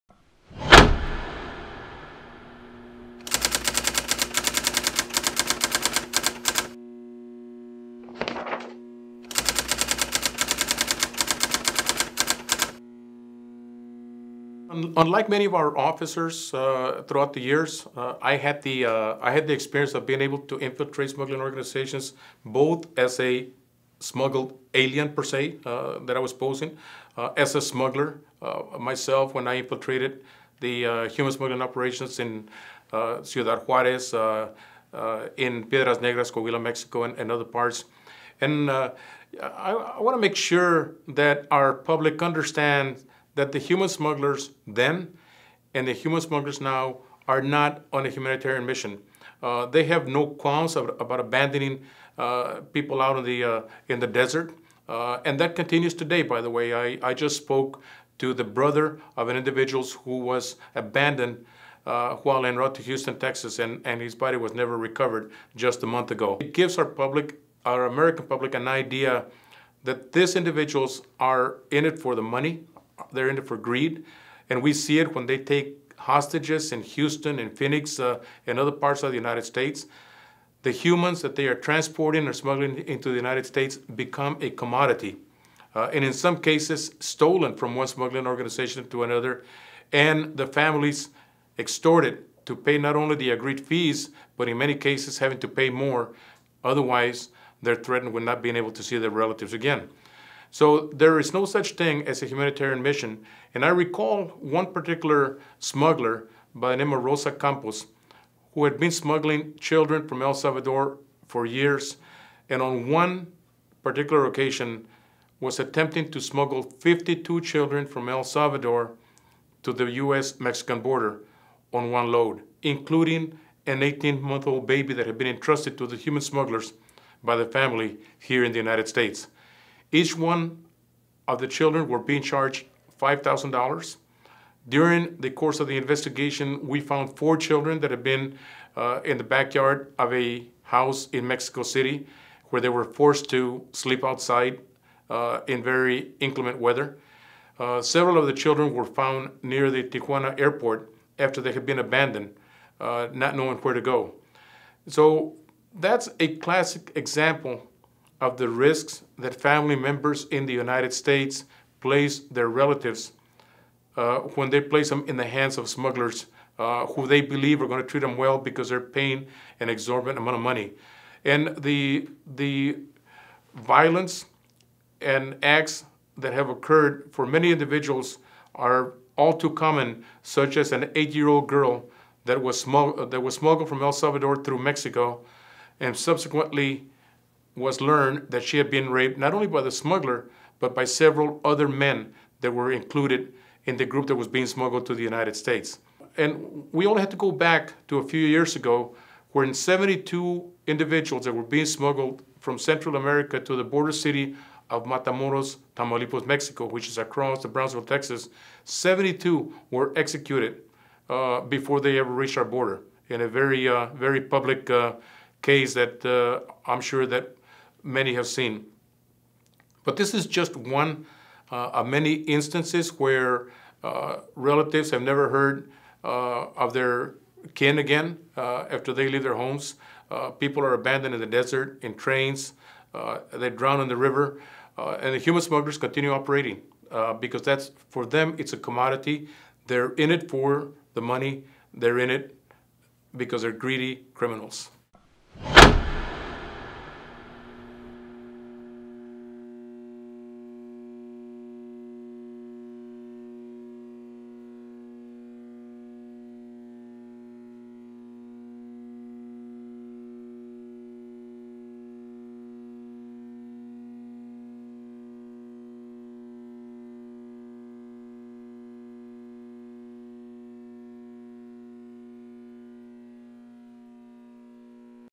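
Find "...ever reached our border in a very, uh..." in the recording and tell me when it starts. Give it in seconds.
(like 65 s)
211 s.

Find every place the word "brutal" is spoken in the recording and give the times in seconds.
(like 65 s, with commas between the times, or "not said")
not said.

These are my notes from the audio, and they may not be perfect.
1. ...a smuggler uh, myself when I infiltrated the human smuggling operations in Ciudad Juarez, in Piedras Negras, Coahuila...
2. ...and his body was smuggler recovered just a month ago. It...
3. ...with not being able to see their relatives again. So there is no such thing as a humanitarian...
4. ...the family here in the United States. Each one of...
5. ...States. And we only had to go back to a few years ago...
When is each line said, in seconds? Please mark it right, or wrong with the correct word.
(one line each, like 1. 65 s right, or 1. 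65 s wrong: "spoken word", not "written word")
1. 27 s right
2. 63 s wrong: "never", not "smuggler"
3. 98 s right
4. 127 s right
5. 195 s right.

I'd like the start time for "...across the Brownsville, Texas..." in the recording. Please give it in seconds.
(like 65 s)
206 s.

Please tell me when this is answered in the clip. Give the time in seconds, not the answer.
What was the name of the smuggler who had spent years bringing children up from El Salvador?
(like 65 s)
107 s.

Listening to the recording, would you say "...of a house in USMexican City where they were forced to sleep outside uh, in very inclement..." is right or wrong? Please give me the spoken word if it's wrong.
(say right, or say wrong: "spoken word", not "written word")
wrong: "Mexico", not "USMexican".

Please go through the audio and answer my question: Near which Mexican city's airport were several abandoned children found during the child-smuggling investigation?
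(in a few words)
Tijuana.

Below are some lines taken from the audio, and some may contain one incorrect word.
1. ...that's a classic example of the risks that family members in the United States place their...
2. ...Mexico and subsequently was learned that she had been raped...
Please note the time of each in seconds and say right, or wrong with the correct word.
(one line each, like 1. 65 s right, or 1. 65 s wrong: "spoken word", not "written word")
1. 155 s right
2. 184 s right.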